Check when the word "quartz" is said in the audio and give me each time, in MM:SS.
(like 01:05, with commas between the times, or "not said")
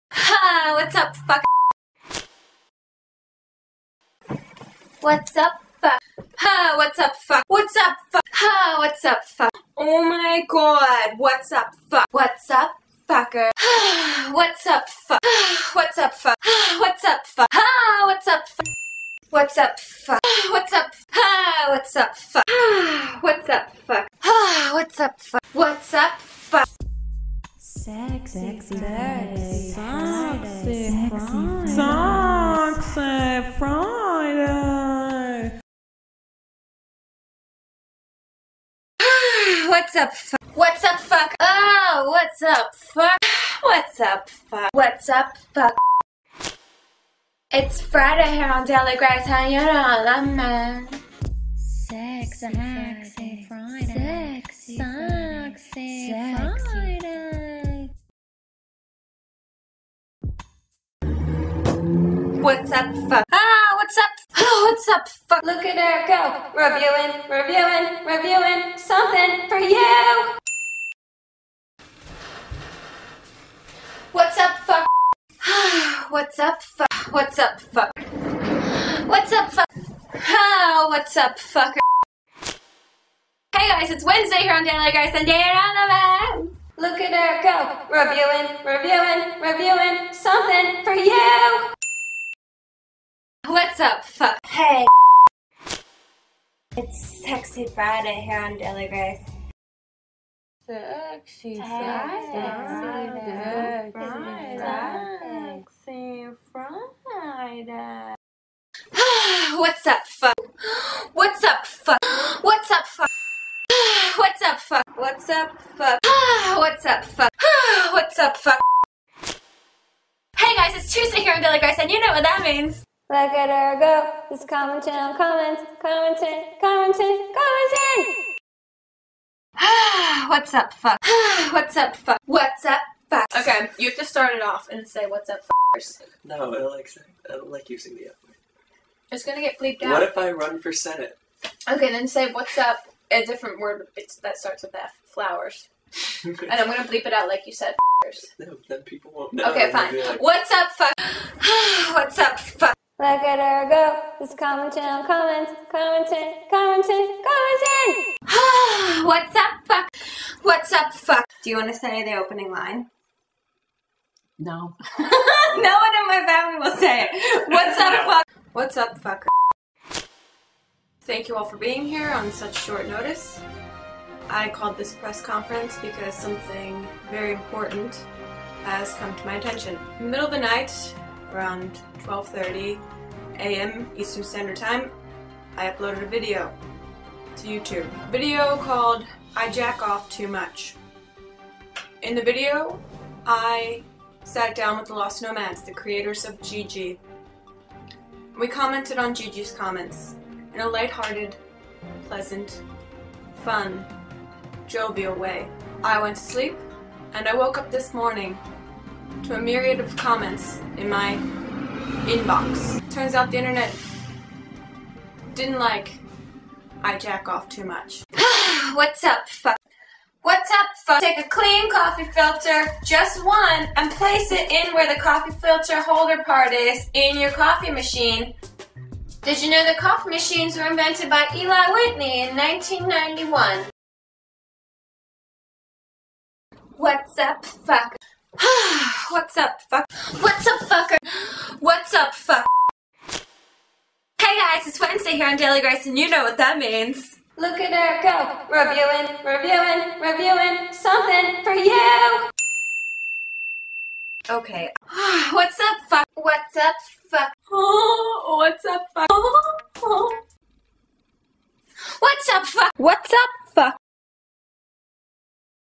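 not said.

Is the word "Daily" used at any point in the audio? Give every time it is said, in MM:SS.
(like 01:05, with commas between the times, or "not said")
00:48, 01:24, 01:38, 02:01, 04:05.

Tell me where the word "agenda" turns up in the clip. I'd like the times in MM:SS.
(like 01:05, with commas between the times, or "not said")
not said.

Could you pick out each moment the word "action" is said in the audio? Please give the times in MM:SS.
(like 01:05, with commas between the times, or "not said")
not said.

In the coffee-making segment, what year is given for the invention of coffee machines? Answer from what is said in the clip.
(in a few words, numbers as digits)
1991.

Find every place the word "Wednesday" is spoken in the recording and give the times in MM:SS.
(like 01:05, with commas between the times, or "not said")
01:24, 04:04.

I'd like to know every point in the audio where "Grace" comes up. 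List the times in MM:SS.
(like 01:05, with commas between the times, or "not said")
00:48, 01:38, 02:01, 04:05.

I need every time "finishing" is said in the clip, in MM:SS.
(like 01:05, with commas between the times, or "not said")
not said.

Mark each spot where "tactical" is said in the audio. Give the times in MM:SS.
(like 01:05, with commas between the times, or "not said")
not said.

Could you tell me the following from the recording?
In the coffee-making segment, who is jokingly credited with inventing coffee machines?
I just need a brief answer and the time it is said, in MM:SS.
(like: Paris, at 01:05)
Eli Whitney, at 03:51.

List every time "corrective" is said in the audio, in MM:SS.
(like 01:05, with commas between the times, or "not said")
not said.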